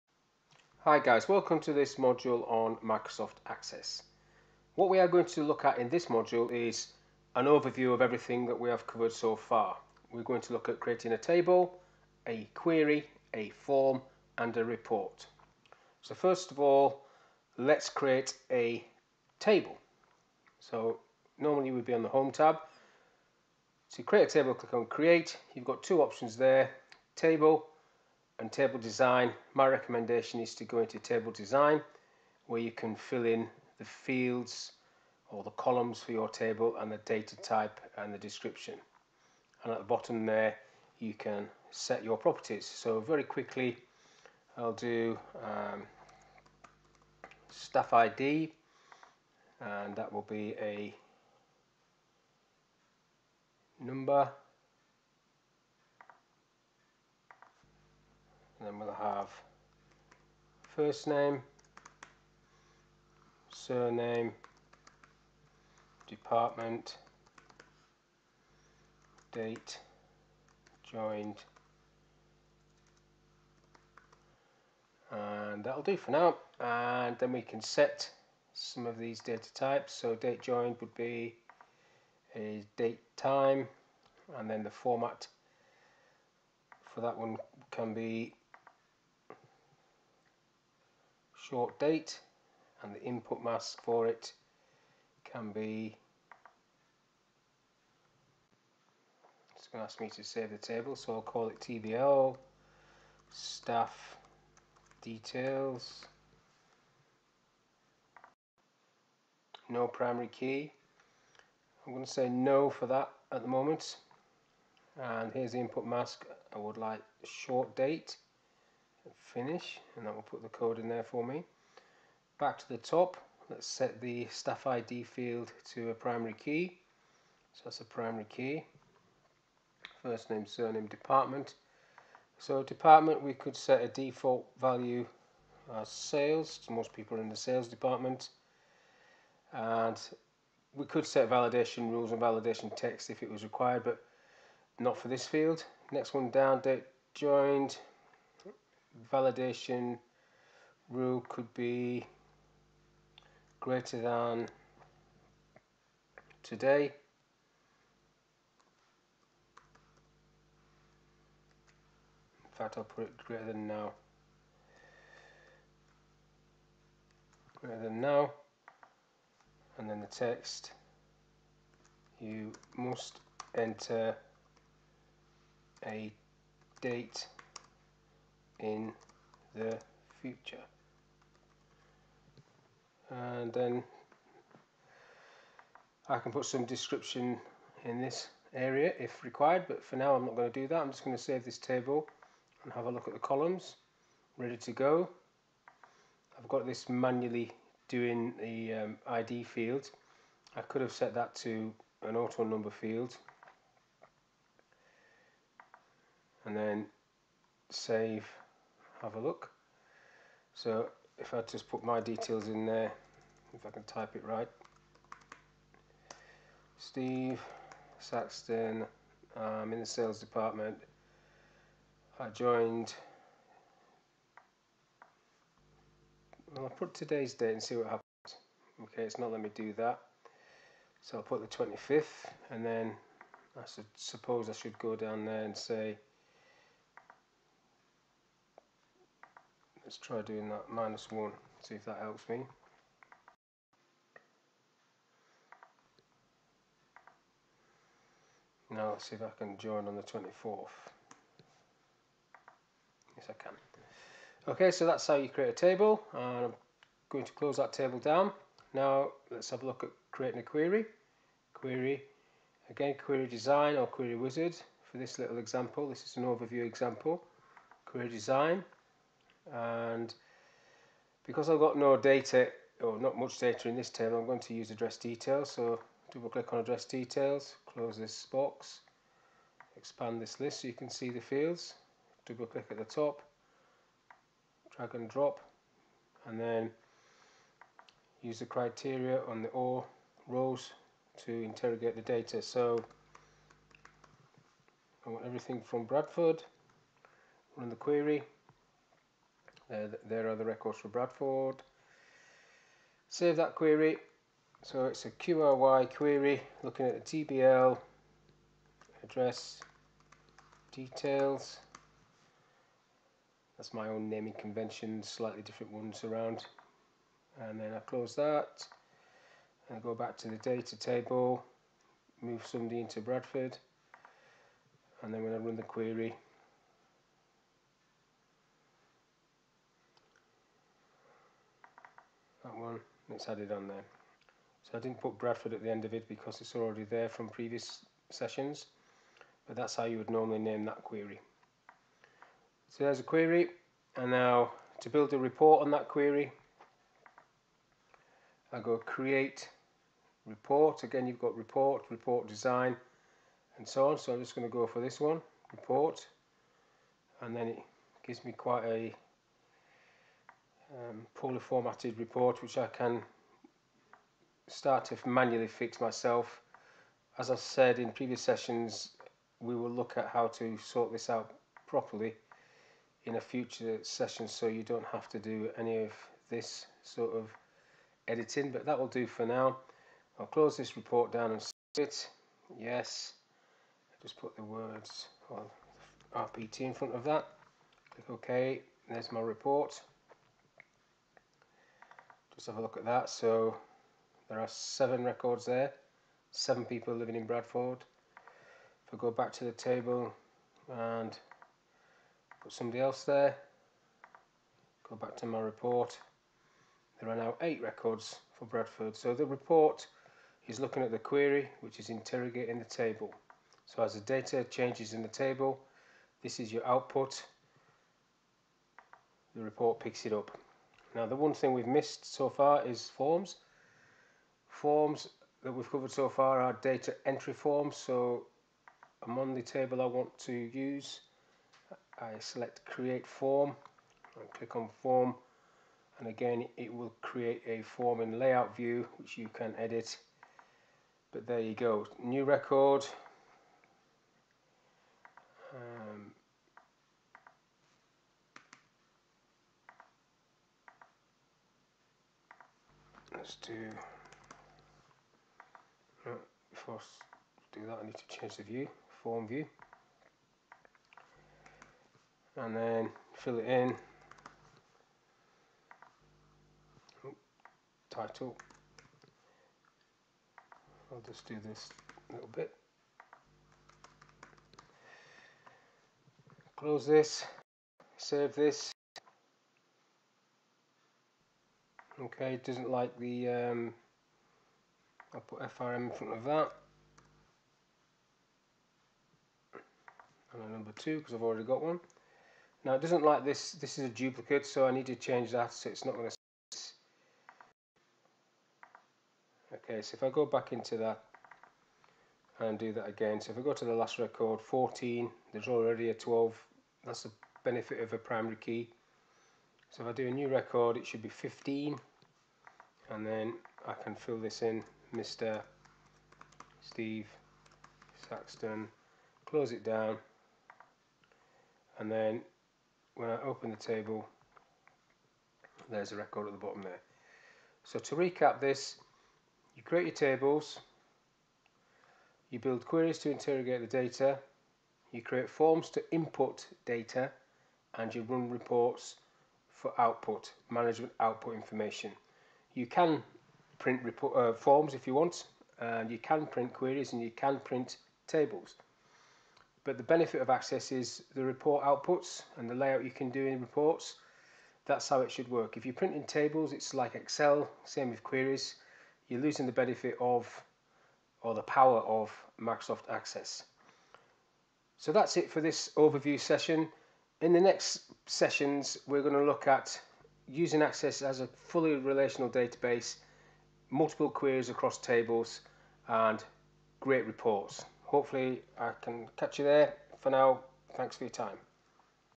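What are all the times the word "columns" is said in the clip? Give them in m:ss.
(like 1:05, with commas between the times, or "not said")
0:35, 3:13.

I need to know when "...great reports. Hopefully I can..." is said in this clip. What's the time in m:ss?
9:36.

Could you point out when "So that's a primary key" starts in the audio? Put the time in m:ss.
2:07.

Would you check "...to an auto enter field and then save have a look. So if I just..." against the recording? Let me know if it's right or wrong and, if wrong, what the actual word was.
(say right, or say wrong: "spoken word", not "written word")
wrong: "number", not "enter".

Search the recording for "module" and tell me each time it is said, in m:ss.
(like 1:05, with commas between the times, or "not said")
0:01, 0:06.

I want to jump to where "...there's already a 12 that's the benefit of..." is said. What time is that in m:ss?
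8:25.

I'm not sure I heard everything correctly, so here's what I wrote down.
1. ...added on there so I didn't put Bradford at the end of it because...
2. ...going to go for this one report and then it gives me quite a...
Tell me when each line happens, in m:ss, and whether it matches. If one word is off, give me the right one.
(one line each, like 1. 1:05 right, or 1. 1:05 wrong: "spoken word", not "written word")
1. 5:33 right
2. 5:54 right.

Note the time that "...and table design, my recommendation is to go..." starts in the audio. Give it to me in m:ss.
0:28.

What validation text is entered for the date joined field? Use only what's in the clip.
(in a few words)
You must enter a date in the future.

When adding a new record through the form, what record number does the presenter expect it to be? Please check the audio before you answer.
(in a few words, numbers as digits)
15.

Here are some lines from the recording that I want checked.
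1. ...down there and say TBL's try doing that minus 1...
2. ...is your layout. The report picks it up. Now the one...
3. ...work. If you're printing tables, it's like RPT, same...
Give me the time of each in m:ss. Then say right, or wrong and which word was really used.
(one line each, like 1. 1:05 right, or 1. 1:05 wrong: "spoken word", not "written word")
1. 3:54 wrong: "Let", not "TBL"
2. 6:56 wrong: "output", not "layout"
3. 9:15 wrong: "Excel", not "RPT".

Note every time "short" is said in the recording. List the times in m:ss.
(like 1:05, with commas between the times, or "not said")
1:31, 1:57.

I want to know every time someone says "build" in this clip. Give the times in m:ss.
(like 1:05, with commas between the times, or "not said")
5:44, 8:52.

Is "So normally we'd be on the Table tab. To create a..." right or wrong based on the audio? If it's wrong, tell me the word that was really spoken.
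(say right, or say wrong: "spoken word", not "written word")
wrong: "Home", not "Table".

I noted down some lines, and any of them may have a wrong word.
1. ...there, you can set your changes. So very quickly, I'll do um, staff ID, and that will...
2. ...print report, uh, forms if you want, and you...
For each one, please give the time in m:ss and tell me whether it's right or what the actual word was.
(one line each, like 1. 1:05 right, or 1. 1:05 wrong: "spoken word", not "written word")
1. 0:40 wrong: "properties", not "changes"
2. 9:03 right.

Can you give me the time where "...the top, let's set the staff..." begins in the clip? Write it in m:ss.
2:02.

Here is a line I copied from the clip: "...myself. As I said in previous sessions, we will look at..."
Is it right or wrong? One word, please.
right.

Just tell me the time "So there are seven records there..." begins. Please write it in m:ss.
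6:33.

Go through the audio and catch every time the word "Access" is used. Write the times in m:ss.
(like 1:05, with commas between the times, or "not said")
0:03, 9:10, 9:22, 9:30.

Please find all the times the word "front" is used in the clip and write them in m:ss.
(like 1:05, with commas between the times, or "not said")
6:26, 8:05.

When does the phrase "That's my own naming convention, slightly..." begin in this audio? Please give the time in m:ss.
5:13.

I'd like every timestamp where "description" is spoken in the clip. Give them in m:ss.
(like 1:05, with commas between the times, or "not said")
0:38, 3:06.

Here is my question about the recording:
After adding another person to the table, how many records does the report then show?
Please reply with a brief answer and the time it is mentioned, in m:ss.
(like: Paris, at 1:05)
8, at 6:47.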